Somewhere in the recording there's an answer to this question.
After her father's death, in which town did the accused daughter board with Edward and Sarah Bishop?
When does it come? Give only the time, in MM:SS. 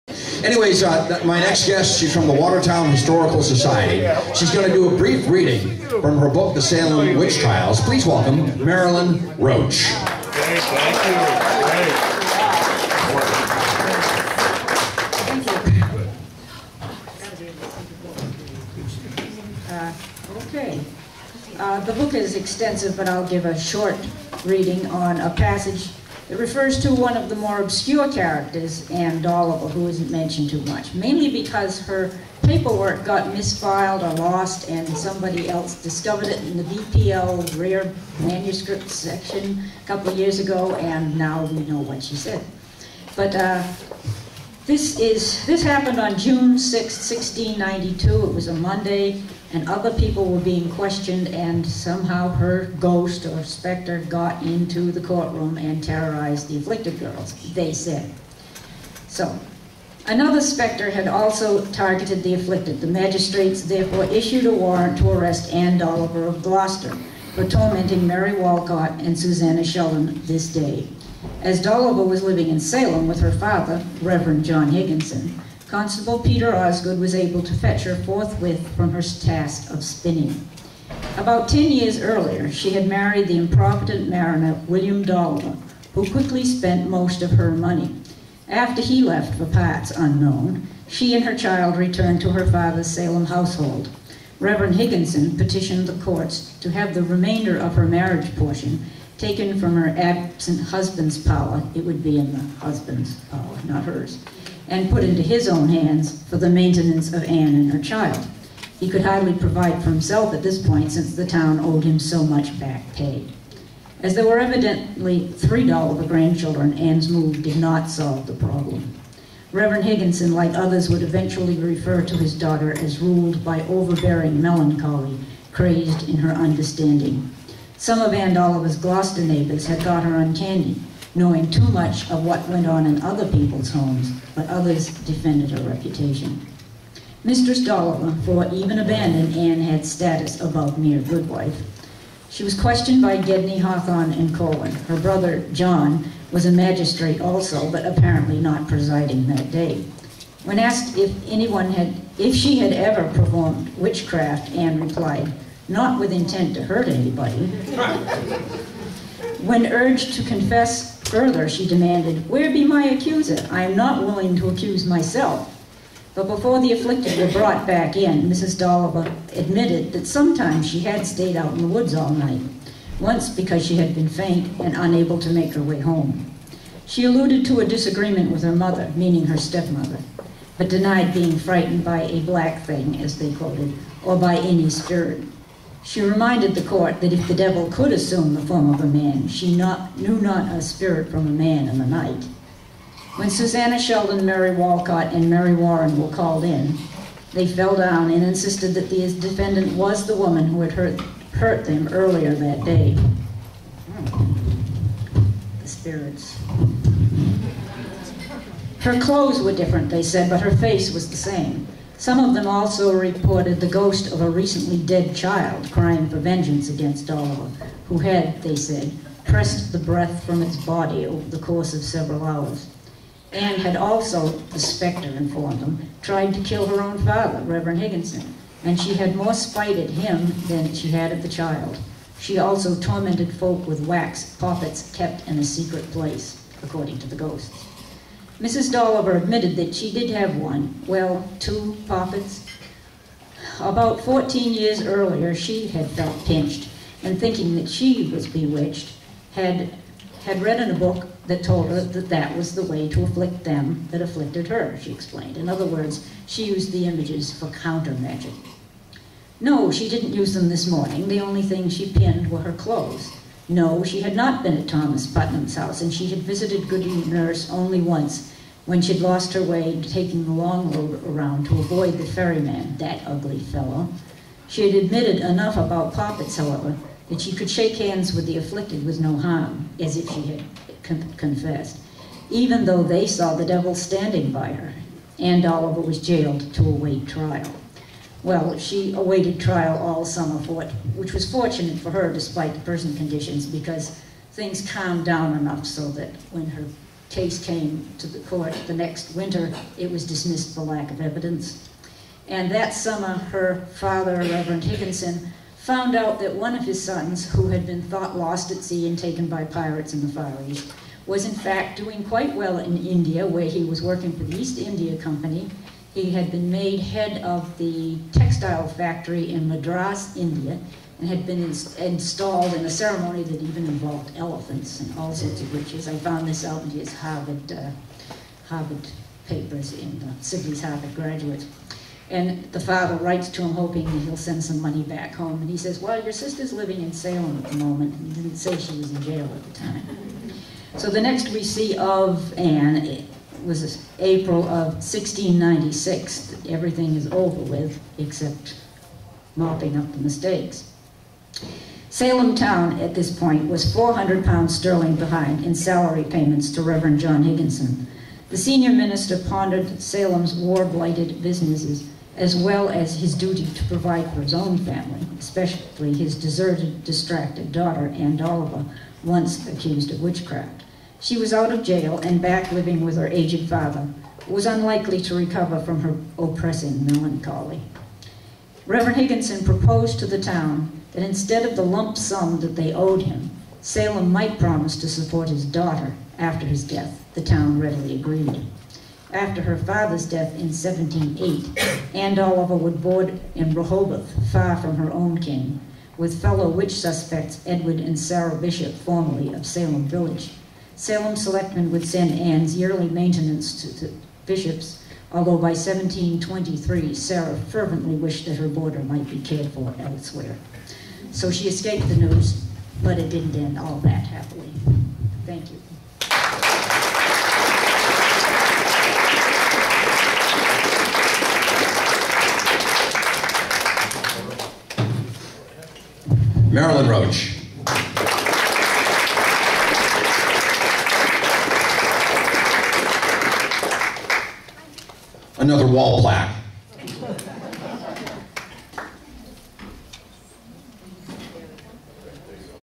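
06:33.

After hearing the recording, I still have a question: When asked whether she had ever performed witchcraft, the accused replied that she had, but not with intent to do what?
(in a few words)
Hurt anybody.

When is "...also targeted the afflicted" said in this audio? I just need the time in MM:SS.
01:01.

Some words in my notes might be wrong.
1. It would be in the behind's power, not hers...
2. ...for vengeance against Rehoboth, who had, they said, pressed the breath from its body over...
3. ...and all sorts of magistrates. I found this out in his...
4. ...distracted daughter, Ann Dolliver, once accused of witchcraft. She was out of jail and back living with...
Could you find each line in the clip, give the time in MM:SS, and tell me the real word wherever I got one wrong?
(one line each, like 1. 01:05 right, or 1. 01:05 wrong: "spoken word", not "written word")
1. 01:41 wrong: "husband", not "behind"
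2. 03:36 wrong: "Dolliver", not "Rehoboth"
3. 05:24 wrong: "witches", not "magistrates"
4. 06:06 right.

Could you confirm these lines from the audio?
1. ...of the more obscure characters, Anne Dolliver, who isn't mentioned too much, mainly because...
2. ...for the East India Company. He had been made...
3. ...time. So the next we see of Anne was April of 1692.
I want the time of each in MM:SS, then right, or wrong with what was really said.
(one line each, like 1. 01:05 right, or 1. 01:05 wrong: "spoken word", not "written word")
1. 00:27 right
2. 05:14 right
3. 05:39 wrong: "1696", not "1692".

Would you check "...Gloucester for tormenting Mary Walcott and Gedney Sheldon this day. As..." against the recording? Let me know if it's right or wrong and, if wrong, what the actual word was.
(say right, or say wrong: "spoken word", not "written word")
wrong: "Susanna", not "Gedney".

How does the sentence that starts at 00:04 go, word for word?
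She's going to do a brief reading from her book, The Salem Witch Trials.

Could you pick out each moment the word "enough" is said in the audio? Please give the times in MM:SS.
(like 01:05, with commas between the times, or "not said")
04:35, 04:55.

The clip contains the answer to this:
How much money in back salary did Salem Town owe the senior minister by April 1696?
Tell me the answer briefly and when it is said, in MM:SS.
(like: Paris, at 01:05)
400 pounds sterling, at 05:53.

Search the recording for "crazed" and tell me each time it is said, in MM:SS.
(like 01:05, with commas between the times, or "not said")
02:05.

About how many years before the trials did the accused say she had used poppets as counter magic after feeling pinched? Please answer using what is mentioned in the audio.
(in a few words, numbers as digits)
14.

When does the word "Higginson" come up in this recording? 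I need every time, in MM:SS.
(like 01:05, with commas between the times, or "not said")
01:14, 01:34, 01:59, 03:47, 05:04, 05:57, 06:18.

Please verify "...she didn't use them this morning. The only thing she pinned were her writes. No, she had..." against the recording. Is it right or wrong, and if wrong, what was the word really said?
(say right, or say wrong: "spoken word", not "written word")
wrong: "clothes", not "writes".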